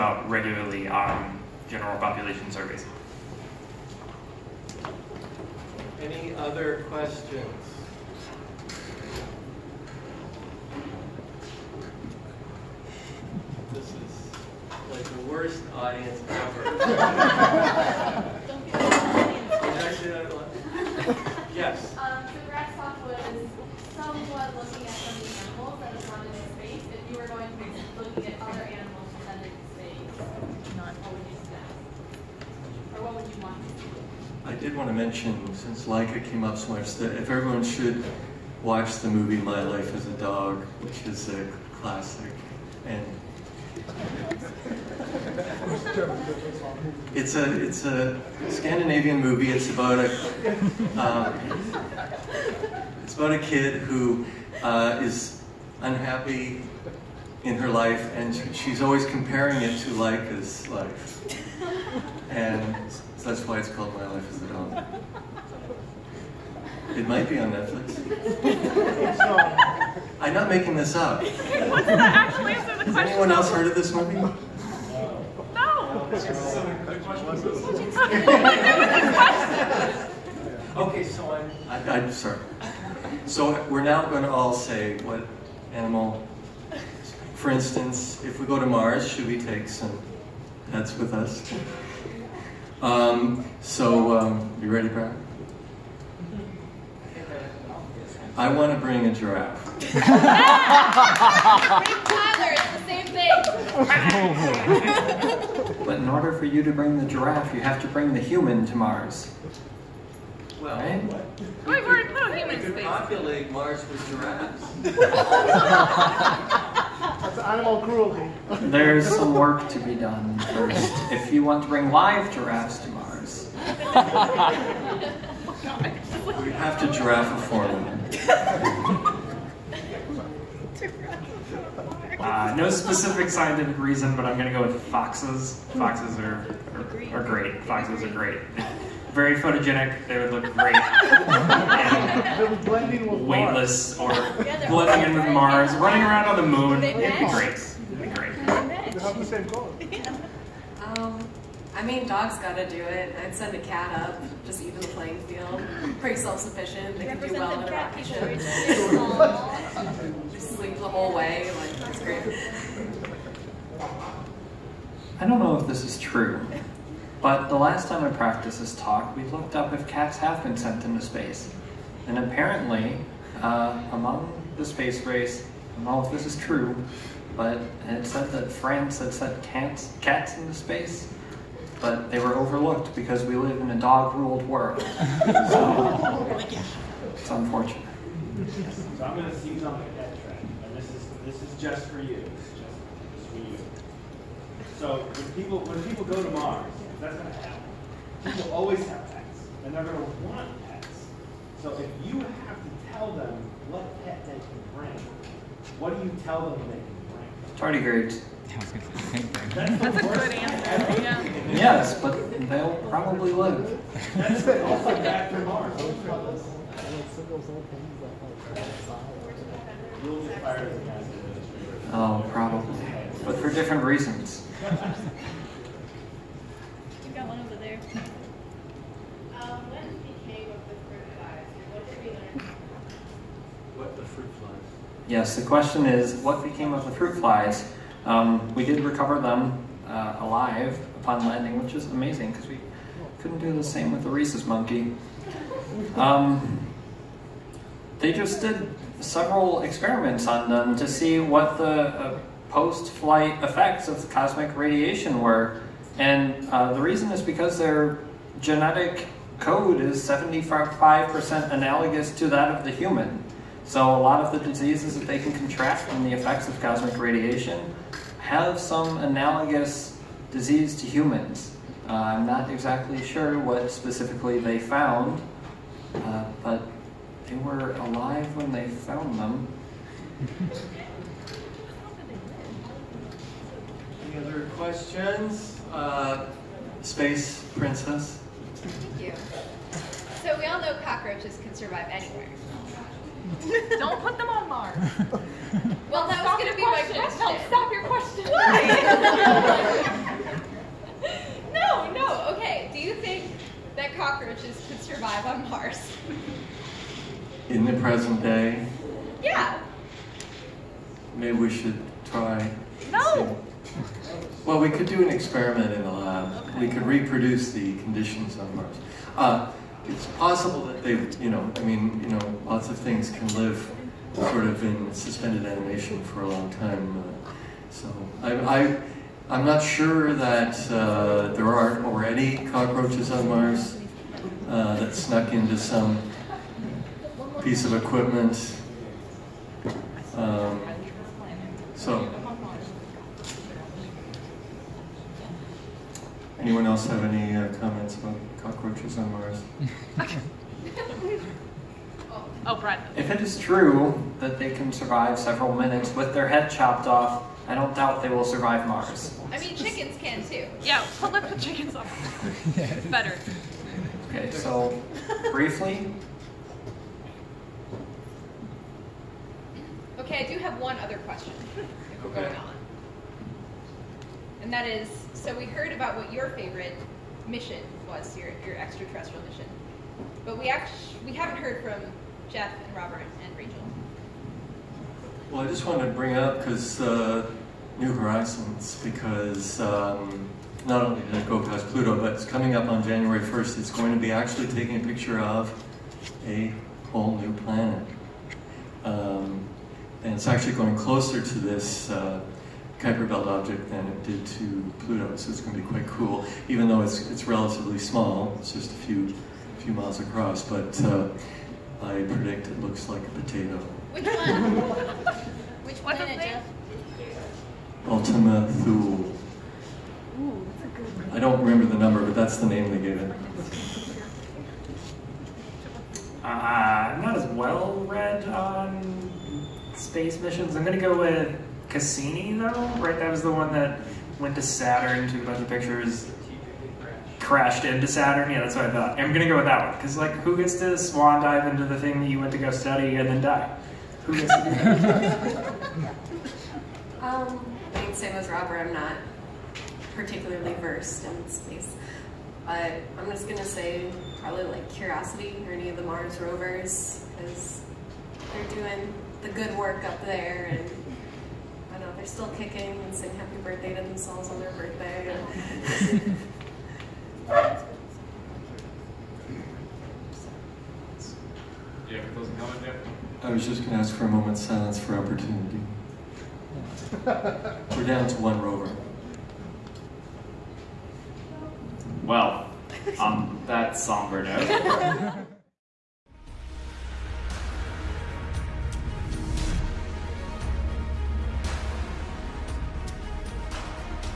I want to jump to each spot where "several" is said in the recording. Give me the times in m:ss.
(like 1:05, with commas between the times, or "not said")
4:09, 5:55.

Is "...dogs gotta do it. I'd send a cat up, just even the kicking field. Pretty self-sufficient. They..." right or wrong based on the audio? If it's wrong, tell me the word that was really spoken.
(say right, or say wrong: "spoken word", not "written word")
wrong: "playing", not "kicking".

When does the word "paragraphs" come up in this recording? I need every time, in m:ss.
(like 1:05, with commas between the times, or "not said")
not said.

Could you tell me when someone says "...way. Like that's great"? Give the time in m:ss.
2:41.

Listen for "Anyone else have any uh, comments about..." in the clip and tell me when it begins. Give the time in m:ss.
5:46.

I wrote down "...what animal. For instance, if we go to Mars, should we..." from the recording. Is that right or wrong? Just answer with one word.
right.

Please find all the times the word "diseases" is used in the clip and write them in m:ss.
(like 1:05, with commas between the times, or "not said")
4:24, 4:30.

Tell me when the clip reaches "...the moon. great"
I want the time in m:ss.
2:26.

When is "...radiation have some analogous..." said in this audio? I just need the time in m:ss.
4:26.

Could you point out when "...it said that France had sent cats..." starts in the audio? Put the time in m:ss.
2:57.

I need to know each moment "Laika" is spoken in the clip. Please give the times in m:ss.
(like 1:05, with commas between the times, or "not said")
0:35, 0:59.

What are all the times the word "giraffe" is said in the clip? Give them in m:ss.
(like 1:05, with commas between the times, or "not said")
1:39, 1:47, 1:54, 2:02, 2:06.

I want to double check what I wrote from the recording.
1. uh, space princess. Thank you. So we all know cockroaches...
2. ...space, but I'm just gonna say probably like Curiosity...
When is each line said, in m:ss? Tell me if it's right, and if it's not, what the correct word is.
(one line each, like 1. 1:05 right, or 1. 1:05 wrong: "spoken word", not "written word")
1. 4:45 right
2. 7:31 right.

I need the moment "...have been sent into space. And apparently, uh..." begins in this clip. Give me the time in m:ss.
2:50.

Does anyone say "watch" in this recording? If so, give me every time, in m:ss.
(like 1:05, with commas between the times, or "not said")
0:38.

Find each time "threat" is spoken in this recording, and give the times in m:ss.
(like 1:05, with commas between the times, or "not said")
not said.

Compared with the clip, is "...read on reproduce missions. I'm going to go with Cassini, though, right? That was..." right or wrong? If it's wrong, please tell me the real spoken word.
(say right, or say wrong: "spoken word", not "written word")
wrong: "space", not "reproduce".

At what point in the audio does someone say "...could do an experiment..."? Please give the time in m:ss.
5:14.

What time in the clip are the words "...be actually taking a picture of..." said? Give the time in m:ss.
6:33.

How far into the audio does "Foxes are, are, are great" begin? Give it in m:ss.
2:15.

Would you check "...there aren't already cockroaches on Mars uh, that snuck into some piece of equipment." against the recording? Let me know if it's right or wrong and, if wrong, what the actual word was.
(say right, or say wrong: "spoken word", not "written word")
right.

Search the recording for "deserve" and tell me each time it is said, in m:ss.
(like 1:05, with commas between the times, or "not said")
not said.